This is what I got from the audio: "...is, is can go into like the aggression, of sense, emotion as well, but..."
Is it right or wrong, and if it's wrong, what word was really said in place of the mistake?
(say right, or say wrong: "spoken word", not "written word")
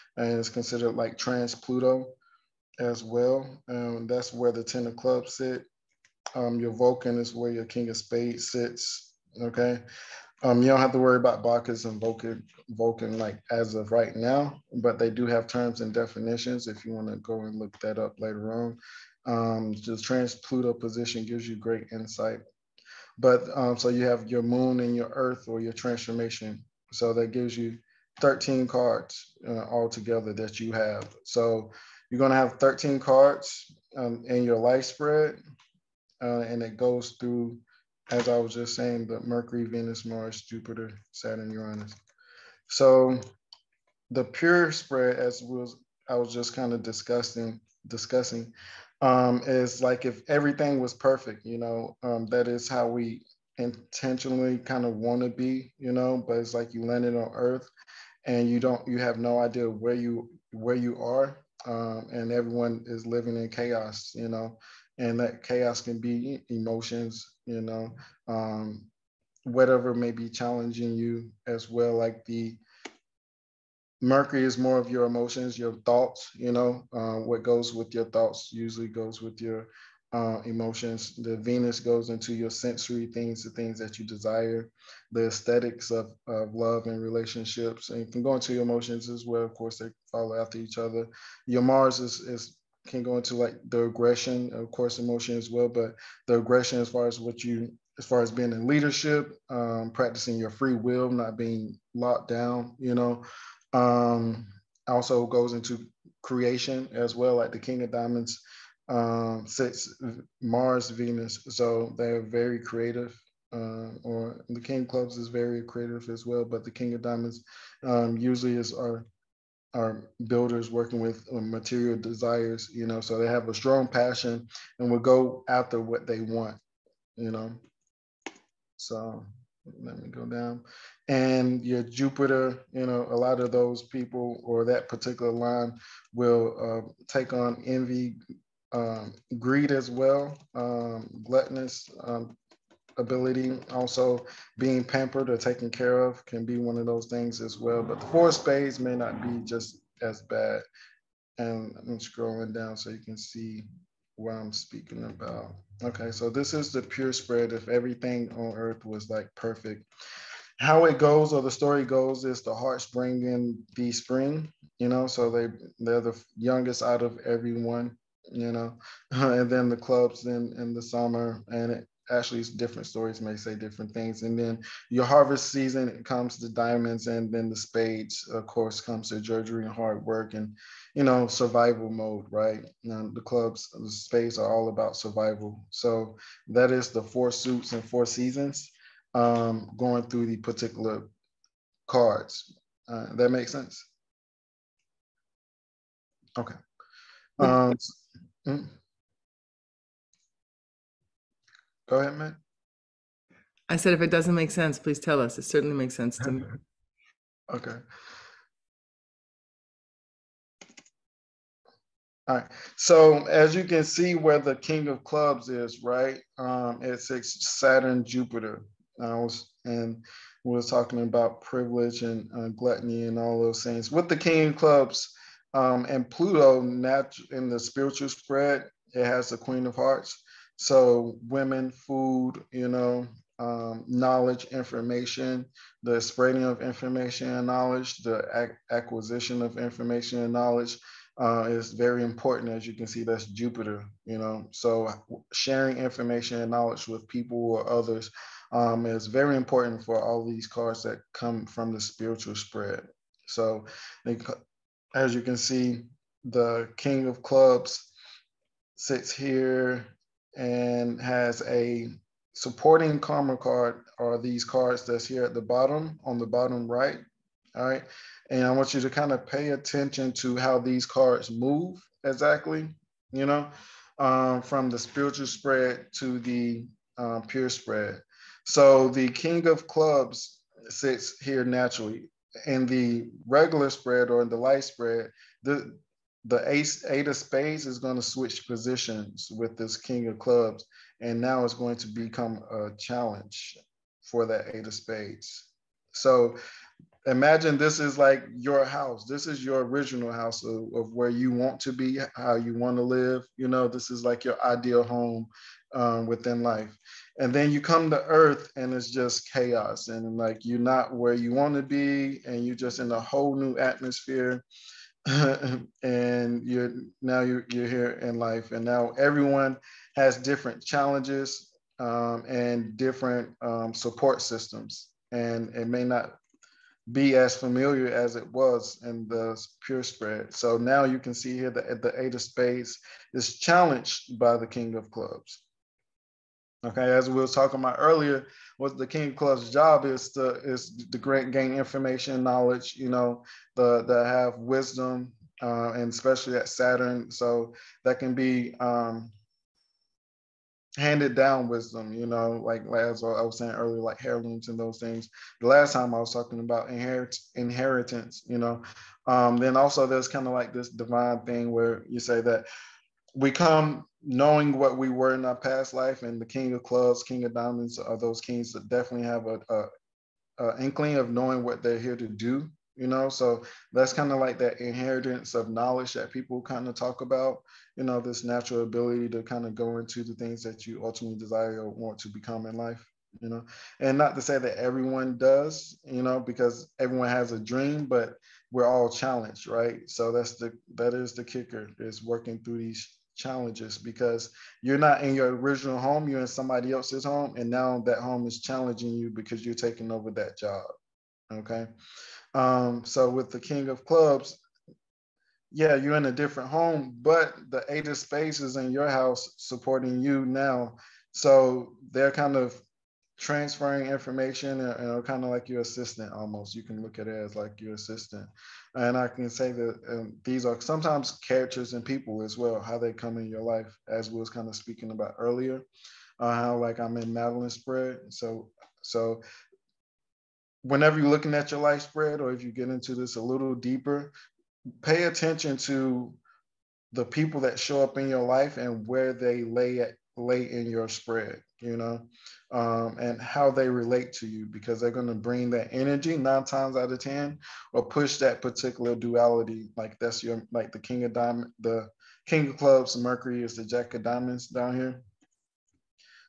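wrong: "course", not "sense".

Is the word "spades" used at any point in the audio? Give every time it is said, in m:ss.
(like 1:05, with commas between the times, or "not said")
0:07, 2:28, 2:57, 3:03, 4:47, 4:54, 5:32, 6:47.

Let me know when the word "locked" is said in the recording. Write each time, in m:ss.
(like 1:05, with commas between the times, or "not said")
1:41.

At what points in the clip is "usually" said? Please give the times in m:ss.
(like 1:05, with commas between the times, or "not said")
1:18, 1:58.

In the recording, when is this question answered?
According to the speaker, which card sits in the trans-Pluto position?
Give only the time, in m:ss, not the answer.
0:04.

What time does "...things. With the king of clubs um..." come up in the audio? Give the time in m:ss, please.
3:43.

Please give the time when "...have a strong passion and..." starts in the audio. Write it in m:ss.
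2:03.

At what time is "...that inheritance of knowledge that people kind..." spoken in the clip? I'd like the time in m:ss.
6:14.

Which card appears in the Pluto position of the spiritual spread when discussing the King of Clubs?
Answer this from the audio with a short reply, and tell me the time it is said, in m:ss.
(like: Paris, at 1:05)
Queen of Hearts, at 3:49.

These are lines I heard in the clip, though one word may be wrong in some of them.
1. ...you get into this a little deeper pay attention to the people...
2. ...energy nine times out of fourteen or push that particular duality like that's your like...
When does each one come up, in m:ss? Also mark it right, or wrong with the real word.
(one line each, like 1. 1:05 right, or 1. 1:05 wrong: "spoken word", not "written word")
1. 7:12 right
2. 7:25 wrong: "ten", not "fourteen".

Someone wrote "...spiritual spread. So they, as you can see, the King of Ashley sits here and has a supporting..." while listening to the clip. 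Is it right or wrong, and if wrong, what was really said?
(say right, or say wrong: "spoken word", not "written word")
wrong: "Clubs", not "Ashley".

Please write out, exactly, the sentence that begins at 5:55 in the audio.
The last time I was talking about inherit inheritance, you know.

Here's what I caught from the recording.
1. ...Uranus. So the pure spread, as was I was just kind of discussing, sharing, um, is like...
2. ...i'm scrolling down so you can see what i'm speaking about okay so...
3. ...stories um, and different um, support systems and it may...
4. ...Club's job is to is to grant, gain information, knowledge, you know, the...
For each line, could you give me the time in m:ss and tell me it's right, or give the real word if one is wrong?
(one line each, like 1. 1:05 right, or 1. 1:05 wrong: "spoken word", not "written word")
1. 0:41 wrong: "discussing", not "sharing"
2. 2:31 right
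3. 5:20 wrong: "challenges", not "stories"
4. 5:39 right.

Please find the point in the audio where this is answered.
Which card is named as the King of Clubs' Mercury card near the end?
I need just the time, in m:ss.
7:33.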